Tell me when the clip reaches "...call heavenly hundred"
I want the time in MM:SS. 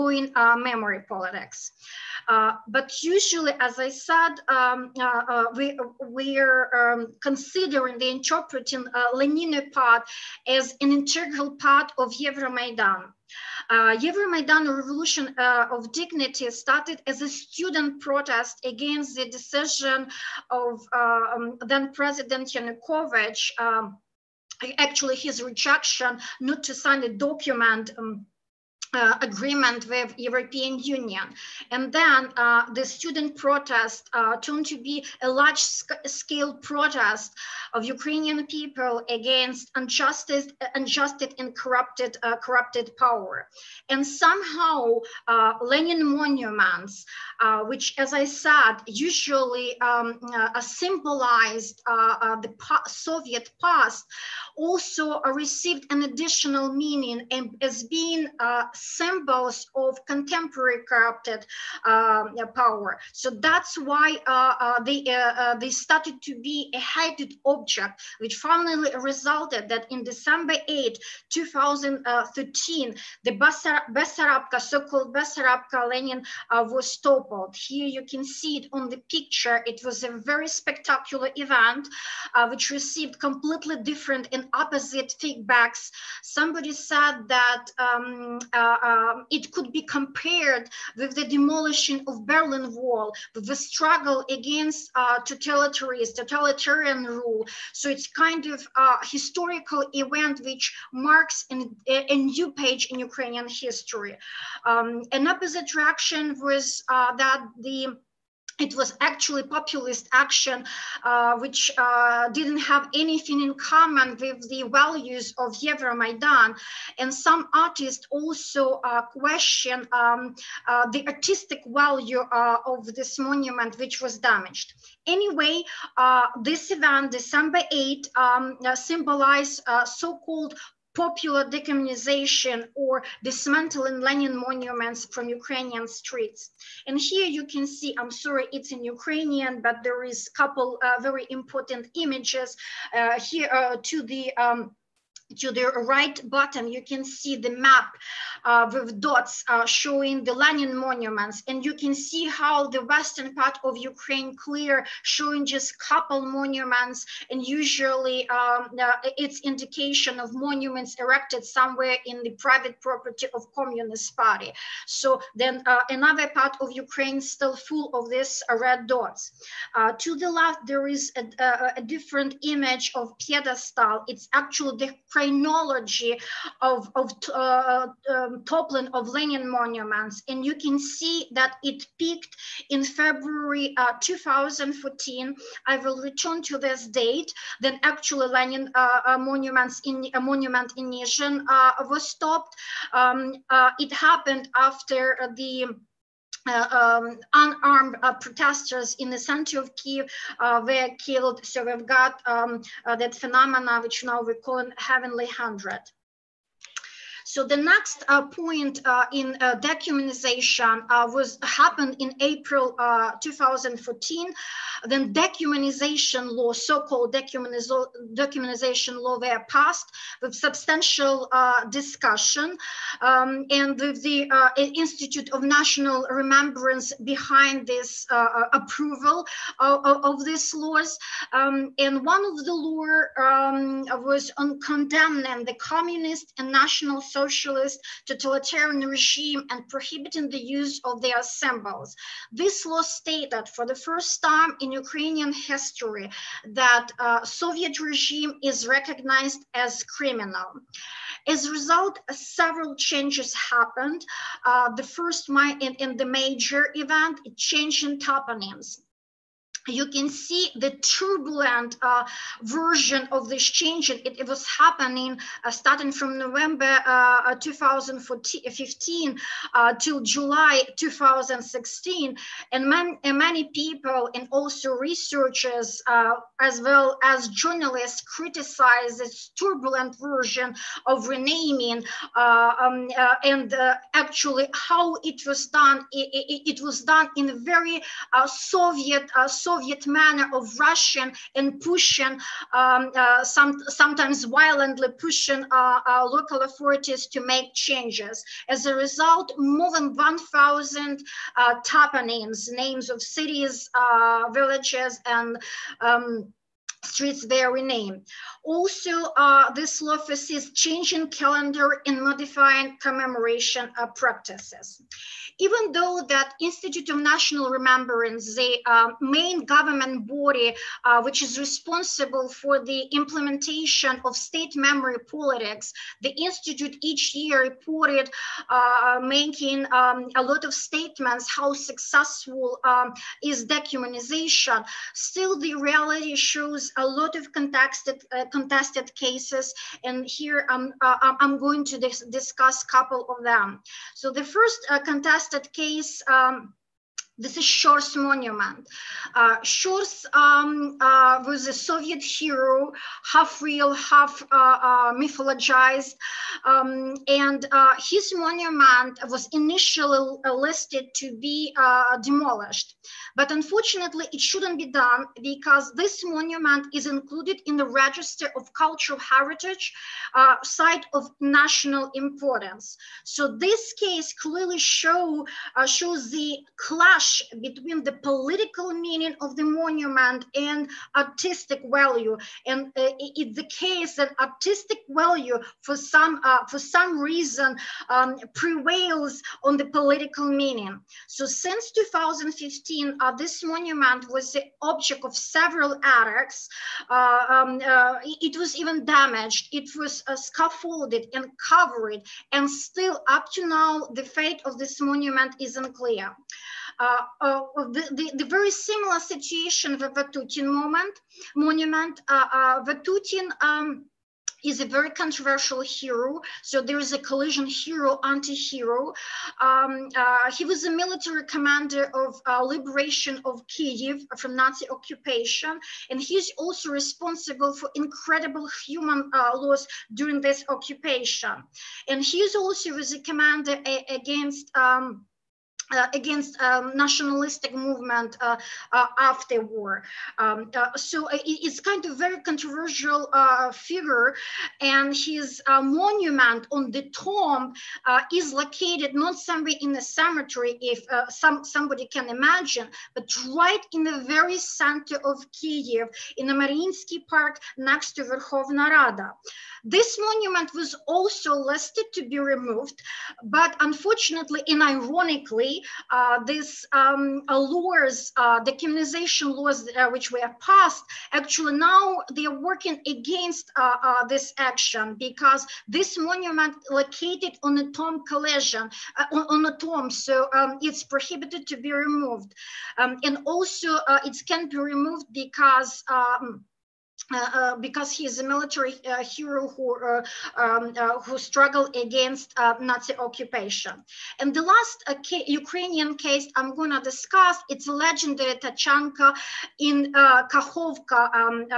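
03:24.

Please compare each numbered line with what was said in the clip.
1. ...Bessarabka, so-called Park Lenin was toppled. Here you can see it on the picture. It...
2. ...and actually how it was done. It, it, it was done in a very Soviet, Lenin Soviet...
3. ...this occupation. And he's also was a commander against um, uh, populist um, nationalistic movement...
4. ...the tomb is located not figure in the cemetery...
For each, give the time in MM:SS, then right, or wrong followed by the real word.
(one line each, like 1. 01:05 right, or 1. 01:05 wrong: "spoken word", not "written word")
1. 01:13 wrong: "Bessarabka", not "Park"
2. 04:43 wrong: "Soviet", not "Lenin"
3. 07:10 wrong: "against", not "populist"
4. 07:26 wrong: "somewhere", not "figure".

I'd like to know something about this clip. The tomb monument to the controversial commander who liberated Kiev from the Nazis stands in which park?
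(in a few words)
Mariinsky Park.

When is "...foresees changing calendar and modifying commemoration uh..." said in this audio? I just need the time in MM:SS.
05:09.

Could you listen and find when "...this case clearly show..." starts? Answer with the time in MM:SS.
06:13.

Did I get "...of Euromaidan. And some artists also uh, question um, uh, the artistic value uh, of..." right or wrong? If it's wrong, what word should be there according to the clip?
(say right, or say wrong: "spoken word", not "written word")
right.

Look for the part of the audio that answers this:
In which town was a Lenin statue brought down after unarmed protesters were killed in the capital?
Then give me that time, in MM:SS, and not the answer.
03:10.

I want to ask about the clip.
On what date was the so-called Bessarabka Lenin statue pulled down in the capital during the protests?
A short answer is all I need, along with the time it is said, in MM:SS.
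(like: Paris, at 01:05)
December 8, 2013, at 01:10.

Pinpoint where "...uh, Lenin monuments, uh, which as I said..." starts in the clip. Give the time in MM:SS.
00:45.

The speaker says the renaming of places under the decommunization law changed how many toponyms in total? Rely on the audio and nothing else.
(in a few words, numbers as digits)
more than 1,000.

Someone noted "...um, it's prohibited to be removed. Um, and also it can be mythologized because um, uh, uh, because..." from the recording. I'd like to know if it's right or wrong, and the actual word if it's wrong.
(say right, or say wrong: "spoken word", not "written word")
wrong: "removed", not "mythologized".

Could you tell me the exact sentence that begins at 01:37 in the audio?
So it's kind of a historical event which marks an, a, new page in Ukrainian history.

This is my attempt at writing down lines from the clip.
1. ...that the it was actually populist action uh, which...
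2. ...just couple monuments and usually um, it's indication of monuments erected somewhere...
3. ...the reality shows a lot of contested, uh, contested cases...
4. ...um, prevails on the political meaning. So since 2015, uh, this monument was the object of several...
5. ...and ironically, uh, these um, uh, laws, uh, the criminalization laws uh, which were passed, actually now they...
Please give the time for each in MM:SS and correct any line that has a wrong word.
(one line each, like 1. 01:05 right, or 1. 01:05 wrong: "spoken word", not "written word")
1. 01:47 right
2. 02:35 right
3. 05:35 right
4. 06:27 right
5. 07:44 right.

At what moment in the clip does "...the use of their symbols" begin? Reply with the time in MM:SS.
04:00.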